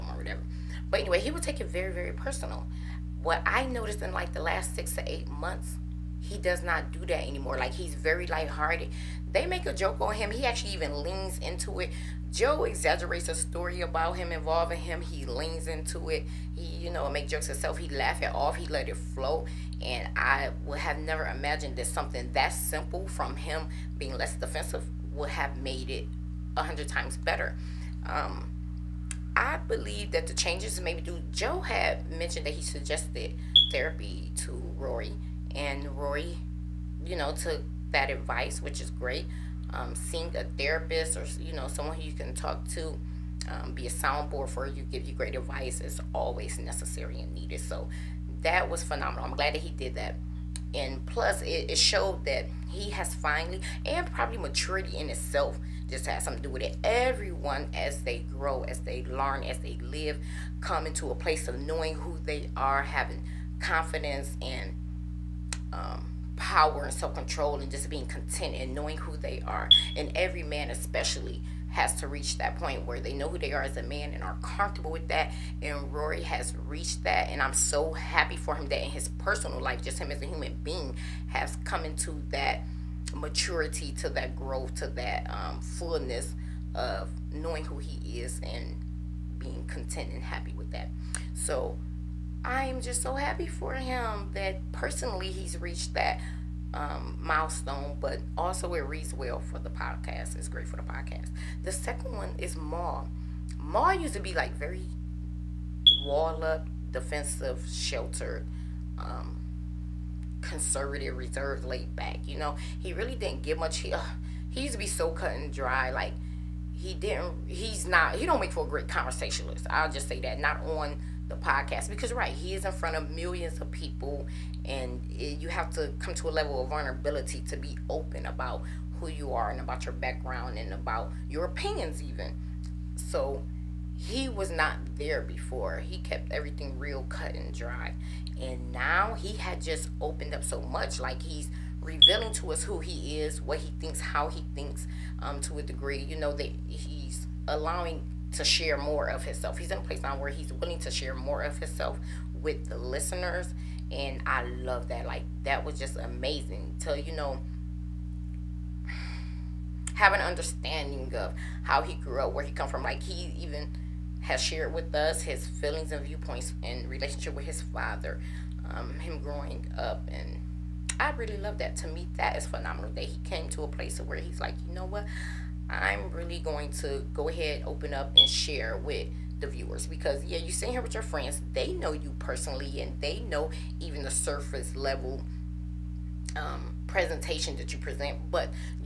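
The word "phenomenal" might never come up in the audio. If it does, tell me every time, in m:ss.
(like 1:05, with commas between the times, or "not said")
0:48, 2:52.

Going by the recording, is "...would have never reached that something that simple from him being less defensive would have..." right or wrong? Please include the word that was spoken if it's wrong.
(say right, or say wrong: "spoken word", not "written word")
wrong: "imagined", not "reached".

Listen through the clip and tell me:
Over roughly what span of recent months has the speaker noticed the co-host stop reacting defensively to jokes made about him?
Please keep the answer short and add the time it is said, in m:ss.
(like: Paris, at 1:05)
6 to 8 months, at 0:04.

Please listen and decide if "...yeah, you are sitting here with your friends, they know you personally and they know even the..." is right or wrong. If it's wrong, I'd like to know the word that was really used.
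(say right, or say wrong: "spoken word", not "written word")
right.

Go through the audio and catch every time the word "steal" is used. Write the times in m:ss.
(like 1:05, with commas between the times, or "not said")
not said.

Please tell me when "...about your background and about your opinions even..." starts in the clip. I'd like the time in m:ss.
2:09.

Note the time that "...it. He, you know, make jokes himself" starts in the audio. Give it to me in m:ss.
0:16.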